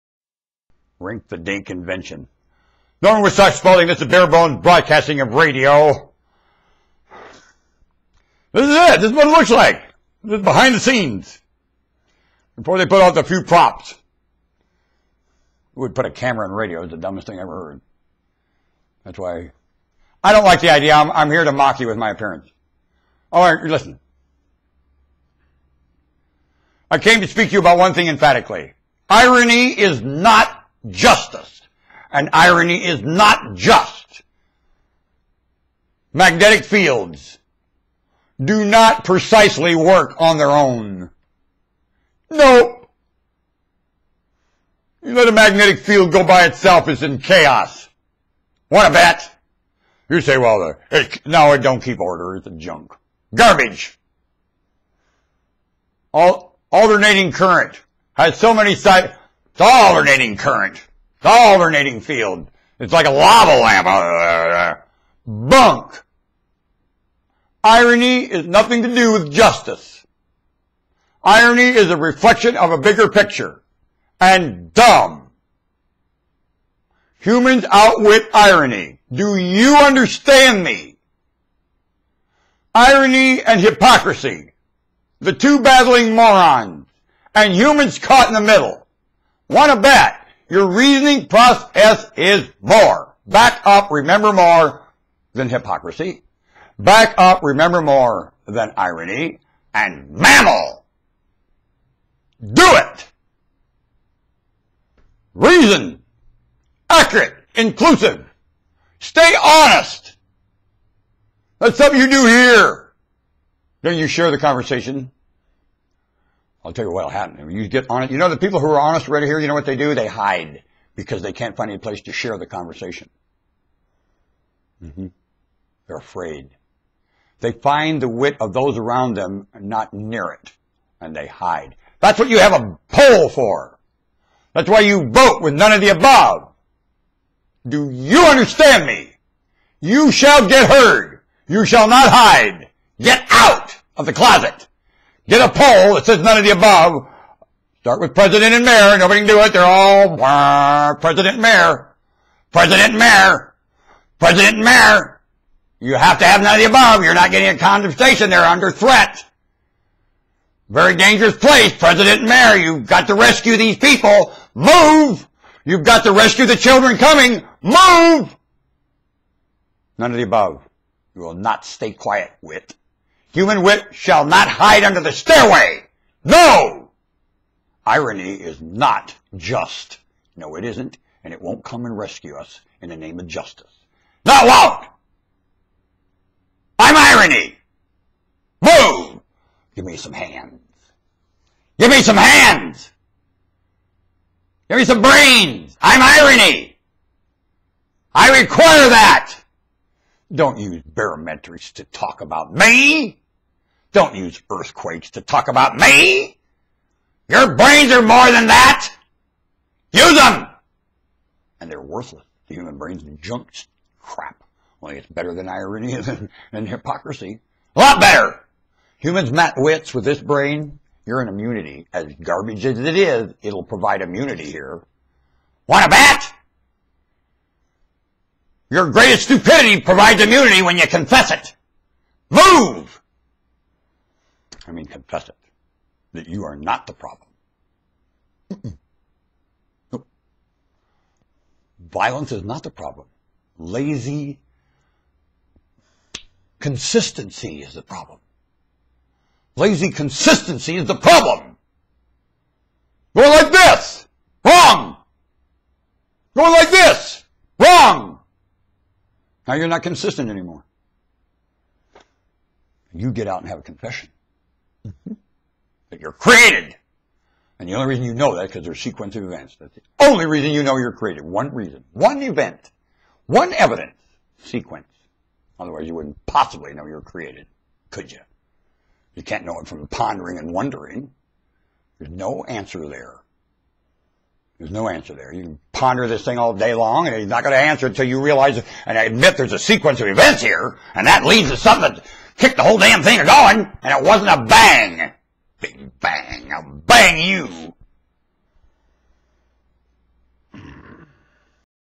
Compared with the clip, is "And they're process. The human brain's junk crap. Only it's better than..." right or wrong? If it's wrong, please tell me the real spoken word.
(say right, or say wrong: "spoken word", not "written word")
wrong: "worthless", not "process".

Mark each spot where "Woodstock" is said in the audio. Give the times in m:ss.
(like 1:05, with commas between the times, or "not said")
0:03.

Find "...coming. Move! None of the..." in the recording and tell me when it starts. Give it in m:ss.
2:46.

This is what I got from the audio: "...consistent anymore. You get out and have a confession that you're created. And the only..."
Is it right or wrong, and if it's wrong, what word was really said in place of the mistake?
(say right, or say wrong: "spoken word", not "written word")
right.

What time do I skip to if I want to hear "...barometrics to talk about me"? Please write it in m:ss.
3:20.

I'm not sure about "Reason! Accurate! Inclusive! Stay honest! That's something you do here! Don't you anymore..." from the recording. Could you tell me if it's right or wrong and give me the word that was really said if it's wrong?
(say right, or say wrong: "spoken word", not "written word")
wrong: "share", not "anymore".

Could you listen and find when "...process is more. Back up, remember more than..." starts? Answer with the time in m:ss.
1:31.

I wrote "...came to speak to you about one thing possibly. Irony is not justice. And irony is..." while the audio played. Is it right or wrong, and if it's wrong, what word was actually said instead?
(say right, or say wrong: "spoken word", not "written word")
wrong: "emphatically", not "possibly".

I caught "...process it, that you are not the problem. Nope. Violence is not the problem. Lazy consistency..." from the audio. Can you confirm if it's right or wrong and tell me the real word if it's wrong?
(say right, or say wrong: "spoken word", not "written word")
wrong: "confess", not "process".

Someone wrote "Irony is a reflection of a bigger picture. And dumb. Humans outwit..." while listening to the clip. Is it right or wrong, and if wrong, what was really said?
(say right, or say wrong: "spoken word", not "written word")
right.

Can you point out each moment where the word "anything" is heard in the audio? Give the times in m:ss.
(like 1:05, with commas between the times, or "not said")
not said.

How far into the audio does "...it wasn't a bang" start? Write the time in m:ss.
4:54.